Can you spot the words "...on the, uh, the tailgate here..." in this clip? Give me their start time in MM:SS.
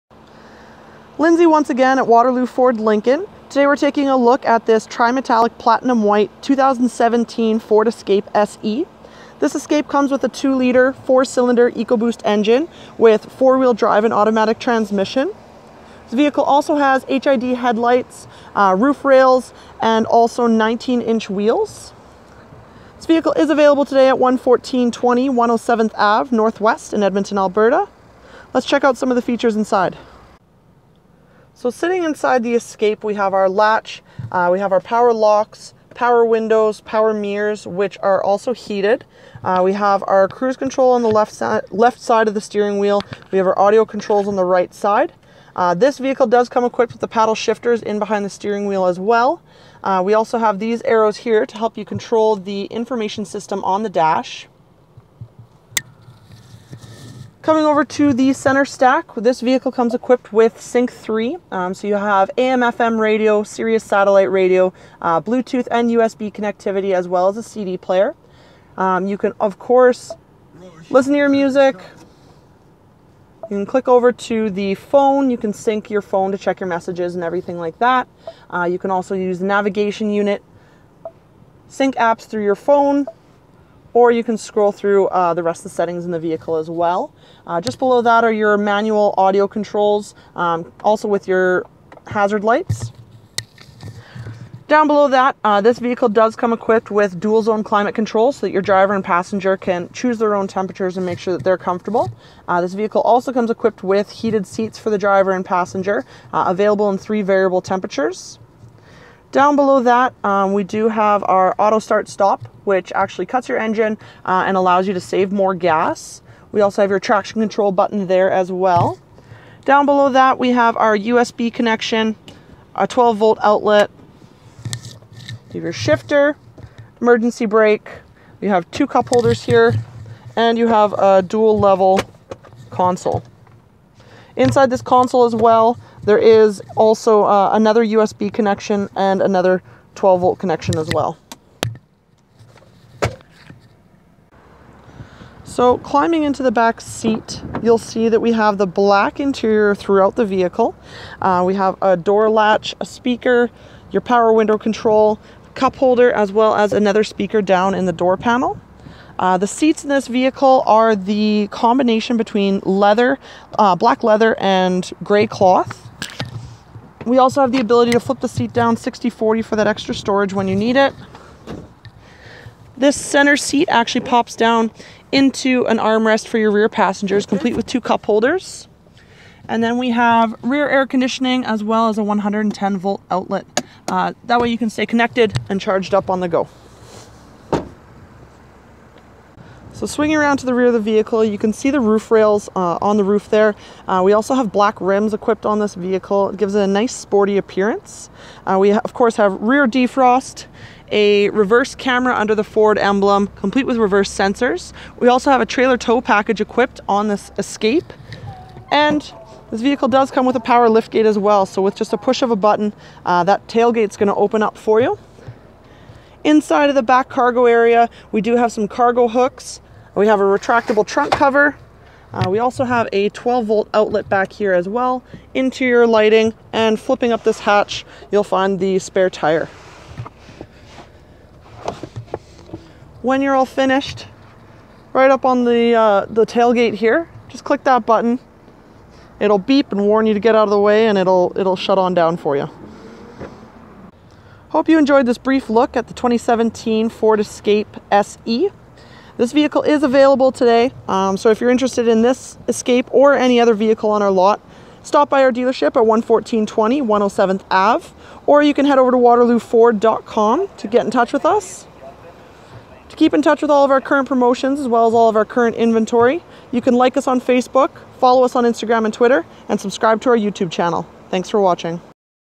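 03:55.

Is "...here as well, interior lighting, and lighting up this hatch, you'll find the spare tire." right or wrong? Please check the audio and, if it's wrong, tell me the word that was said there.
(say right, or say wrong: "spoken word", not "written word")
wrong: "flipping", not "lighting".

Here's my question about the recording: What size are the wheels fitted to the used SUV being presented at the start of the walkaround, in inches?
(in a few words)
19.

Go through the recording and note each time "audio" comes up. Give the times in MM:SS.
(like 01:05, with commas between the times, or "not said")
00:43, 01:29.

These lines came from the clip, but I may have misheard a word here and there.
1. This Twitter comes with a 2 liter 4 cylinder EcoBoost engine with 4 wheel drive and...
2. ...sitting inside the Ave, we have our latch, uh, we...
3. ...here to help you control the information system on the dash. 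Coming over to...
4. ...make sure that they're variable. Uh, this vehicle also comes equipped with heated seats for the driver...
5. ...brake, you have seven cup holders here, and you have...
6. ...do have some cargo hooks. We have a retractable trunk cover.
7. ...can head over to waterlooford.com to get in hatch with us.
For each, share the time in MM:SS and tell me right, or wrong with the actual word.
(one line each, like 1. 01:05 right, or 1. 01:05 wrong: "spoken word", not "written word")
1. 00:09 wrong: "Escape", not "Twitter"
2. 00:31 wrong: "Escape", not "Ave"
3. 00:51 right
4. 01:41 wrong: "comfortable", not "variable"
5. 02:07 wrong: "two", not "seven"
6. 03:38 right
7. 04:18 wrong: "touch", not "hatch".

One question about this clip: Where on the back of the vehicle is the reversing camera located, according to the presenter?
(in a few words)
Under the Ford emblem.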